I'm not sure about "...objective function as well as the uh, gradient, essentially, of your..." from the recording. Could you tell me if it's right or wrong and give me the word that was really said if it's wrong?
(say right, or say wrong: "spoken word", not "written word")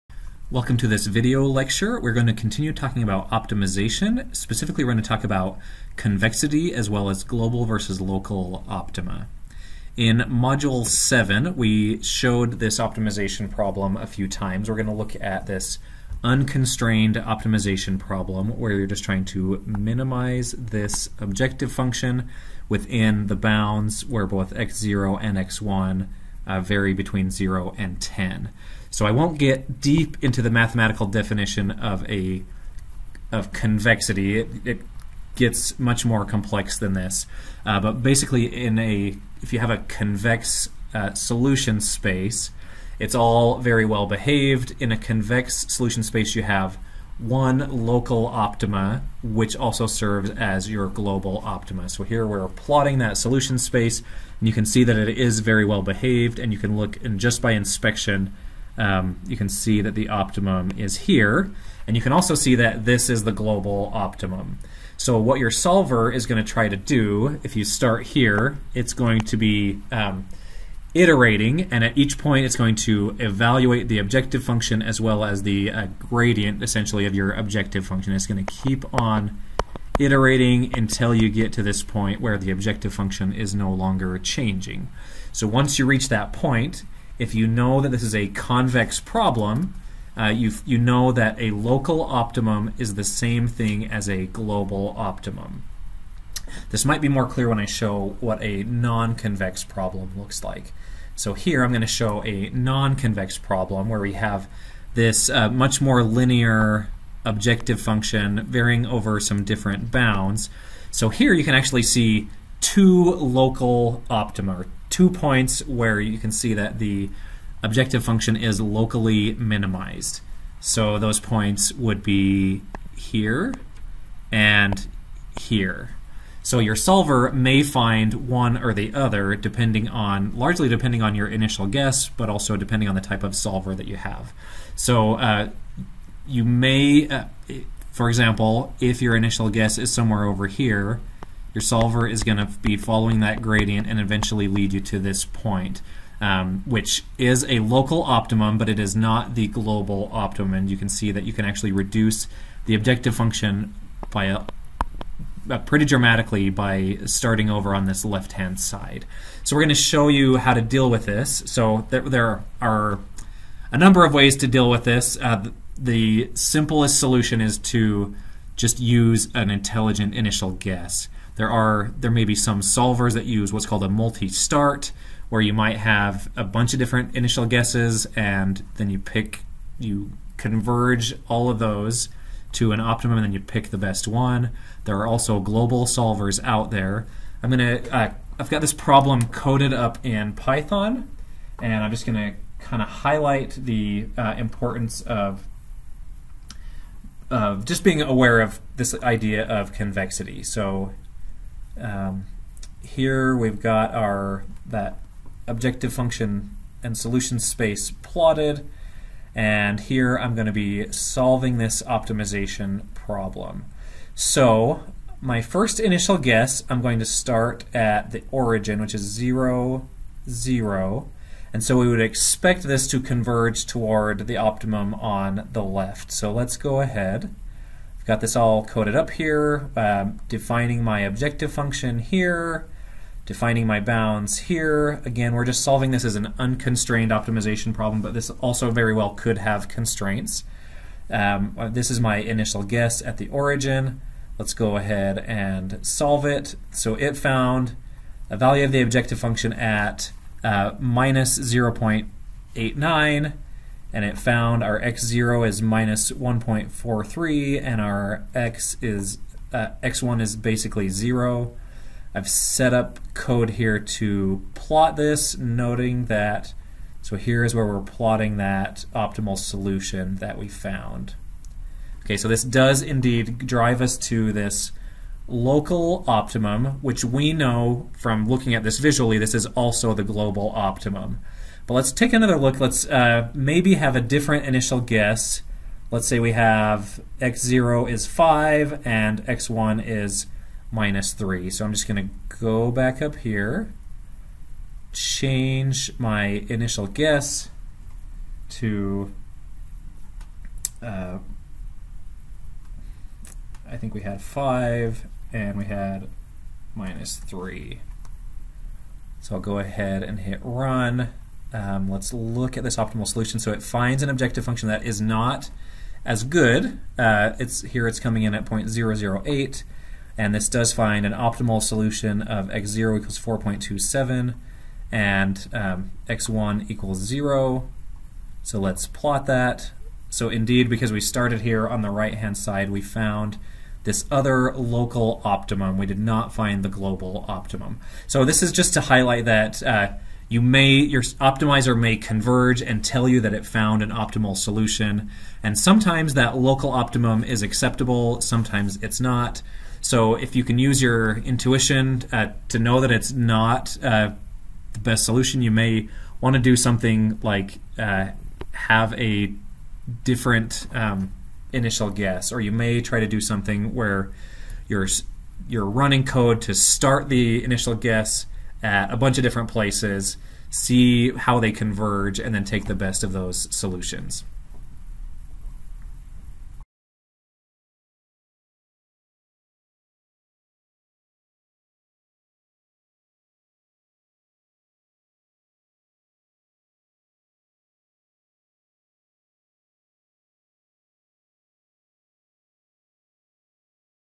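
right.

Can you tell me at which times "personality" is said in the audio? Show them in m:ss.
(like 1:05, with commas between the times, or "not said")
not said.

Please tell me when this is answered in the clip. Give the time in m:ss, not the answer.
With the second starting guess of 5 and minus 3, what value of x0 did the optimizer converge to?
5:23.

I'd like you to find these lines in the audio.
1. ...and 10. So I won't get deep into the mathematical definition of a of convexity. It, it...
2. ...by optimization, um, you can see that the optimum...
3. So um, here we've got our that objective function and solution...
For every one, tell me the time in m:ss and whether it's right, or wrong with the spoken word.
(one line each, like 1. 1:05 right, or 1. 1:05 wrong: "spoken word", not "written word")
1. 0:27 right
2. 0:57 wrong: "inspection", not "optimization"
3. 3:20 right.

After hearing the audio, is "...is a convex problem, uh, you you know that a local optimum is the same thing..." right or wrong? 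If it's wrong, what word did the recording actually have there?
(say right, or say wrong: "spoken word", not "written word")
right.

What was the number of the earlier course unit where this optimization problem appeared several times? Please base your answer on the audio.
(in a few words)
Module 7.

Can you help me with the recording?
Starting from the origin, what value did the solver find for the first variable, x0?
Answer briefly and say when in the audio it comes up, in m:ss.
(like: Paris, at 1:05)
-1.43, at 4:15.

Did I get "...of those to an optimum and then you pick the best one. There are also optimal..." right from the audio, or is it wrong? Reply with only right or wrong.
wrong.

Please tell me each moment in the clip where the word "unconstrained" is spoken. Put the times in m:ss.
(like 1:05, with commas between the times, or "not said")
0:16, 3:56.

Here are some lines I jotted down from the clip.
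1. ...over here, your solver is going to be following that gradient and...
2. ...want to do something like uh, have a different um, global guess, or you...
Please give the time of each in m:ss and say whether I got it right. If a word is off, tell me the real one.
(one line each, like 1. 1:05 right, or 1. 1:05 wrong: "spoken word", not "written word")
1. 2:20 right
2. 5:56 wrong: "initial", not "global".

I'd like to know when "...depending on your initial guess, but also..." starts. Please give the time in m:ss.
2:10.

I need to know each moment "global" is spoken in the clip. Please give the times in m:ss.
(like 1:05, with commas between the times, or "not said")
0:07, 0:50, 1:03, 1:34, 2:29, 3:05, 4:40, 5:36.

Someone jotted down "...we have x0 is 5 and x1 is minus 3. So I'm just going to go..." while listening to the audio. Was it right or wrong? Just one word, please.
right.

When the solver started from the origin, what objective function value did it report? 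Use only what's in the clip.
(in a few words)
-0.89.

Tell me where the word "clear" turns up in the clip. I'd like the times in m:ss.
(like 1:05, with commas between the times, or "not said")
1:37.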